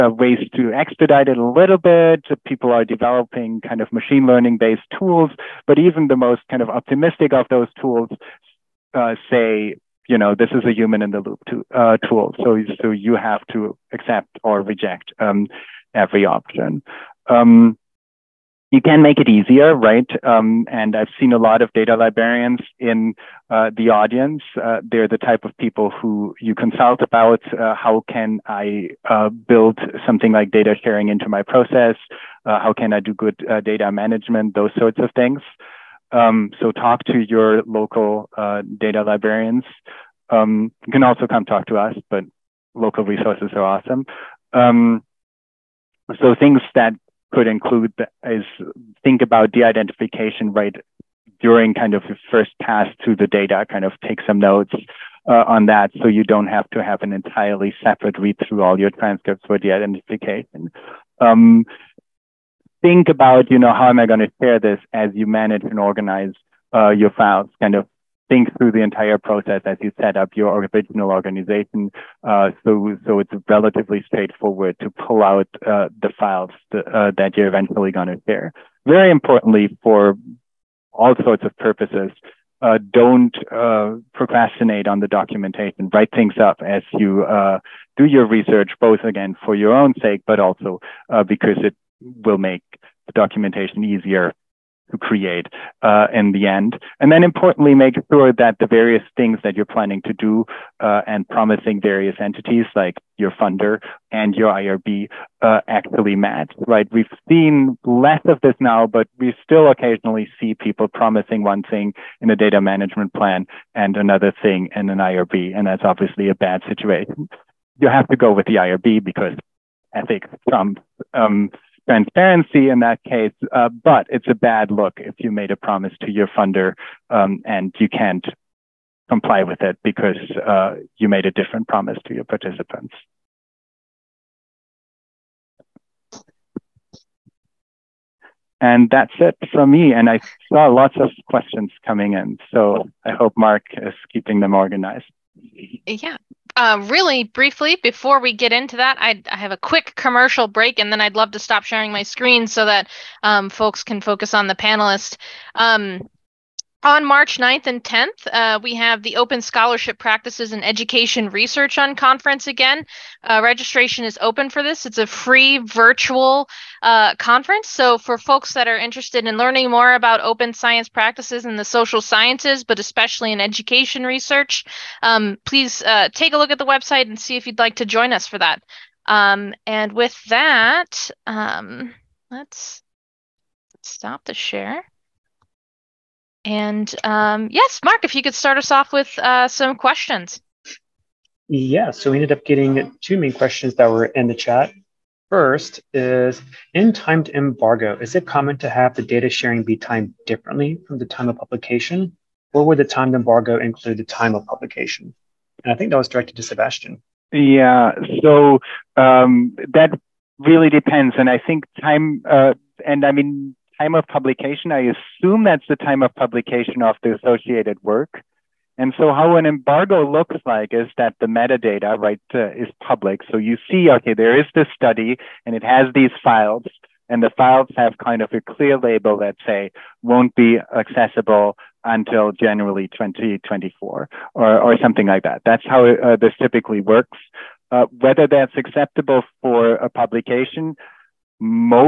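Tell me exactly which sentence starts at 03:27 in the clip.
Yeah, so um, that really depends.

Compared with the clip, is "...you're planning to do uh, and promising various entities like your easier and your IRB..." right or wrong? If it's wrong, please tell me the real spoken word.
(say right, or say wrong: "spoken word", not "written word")
wrong: "funder", not "easier".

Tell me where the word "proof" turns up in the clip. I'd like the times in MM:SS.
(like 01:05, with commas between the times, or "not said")
not said.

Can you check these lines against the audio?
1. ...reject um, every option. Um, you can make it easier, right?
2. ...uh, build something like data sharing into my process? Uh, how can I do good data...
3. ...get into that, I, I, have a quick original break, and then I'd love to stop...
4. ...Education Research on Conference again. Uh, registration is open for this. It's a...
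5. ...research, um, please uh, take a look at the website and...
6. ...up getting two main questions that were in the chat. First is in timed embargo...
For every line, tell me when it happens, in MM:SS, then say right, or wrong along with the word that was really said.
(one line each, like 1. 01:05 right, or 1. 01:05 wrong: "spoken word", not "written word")
1. 00:14 right
2. 00:29 right
3. 02:28 wrong: "commercial", not "original"
4. 02:40 right
5. 02:54 right
6. 03:12 right.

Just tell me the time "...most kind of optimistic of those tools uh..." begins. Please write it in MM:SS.
00:06.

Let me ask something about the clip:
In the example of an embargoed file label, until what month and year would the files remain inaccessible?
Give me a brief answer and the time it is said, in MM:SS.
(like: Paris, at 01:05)
January 2024, at 03:52.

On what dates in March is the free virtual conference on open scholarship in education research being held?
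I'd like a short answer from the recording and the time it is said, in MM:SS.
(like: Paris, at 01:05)
March 9th and 10th, at 02:37.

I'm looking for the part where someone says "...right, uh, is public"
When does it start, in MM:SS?
03:41.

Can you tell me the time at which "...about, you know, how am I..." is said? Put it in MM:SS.
01:03.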